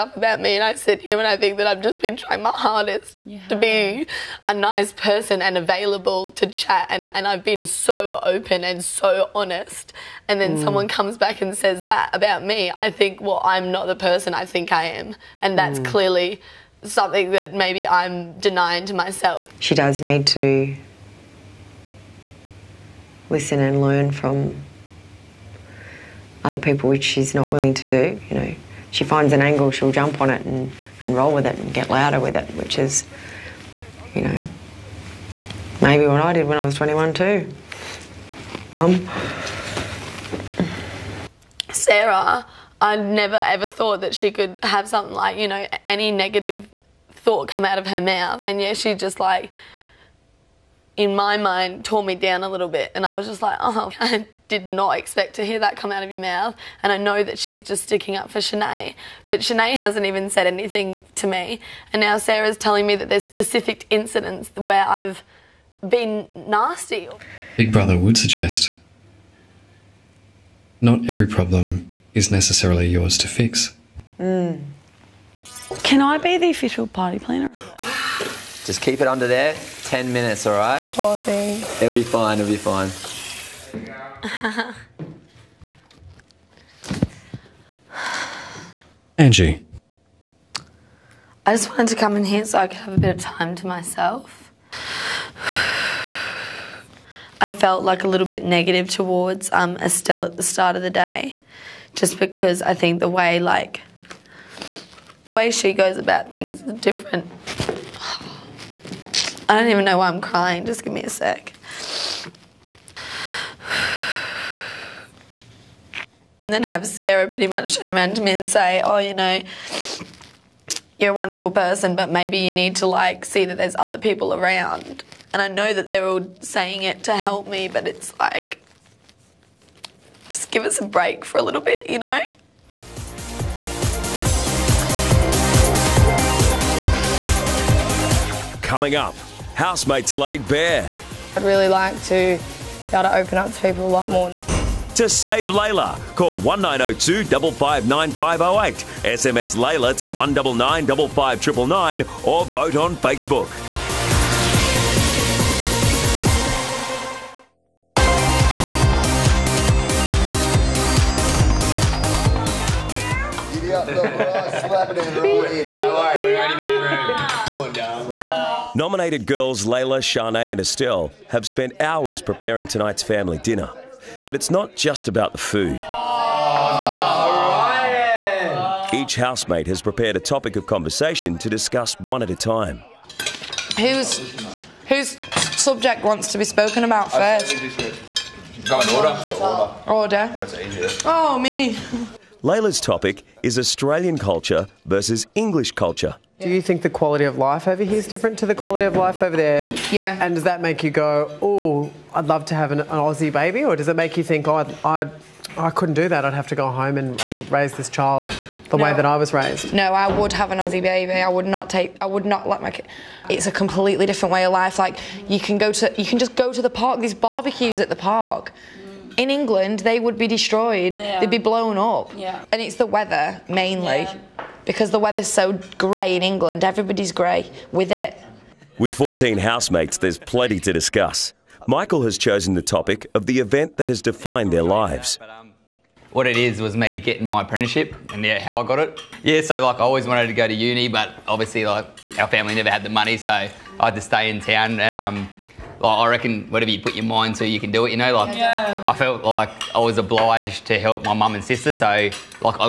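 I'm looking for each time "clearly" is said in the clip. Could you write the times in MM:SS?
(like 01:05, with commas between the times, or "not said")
00:15.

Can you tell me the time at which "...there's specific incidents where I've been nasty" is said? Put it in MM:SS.
01:03.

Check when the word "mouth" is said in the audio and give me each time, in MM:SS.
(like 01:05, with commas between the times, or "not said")
00:48, 00:56.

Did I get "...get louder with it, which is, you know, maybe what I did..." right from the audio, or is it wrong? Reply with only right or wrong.
right.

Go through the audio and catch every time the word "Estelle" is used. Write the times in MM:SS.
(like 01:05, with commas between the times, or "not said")
01:39, 02:50.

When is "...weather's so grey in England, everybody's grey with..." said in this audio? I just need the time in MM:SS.
03:44.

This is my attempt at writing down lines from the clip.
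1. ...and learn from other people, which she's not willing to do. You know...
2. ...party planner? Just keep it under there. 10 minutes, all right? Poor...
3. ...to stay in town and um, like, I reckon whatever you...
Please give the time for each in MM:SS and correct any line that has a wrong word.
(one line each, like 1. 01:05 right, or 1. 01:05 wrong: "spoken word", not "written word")
1. 00:23 right
2. 01:16 right
3. 04:03 right.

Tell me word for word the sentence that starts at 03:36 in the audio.
These barbecues at the park in England, they would be destroyed.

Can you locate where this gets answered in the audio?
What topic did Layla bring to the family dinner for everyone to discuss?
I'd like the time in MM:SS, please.
03:13.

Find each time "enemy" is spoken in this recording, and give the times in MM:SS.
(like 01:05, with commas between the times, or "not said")
not said.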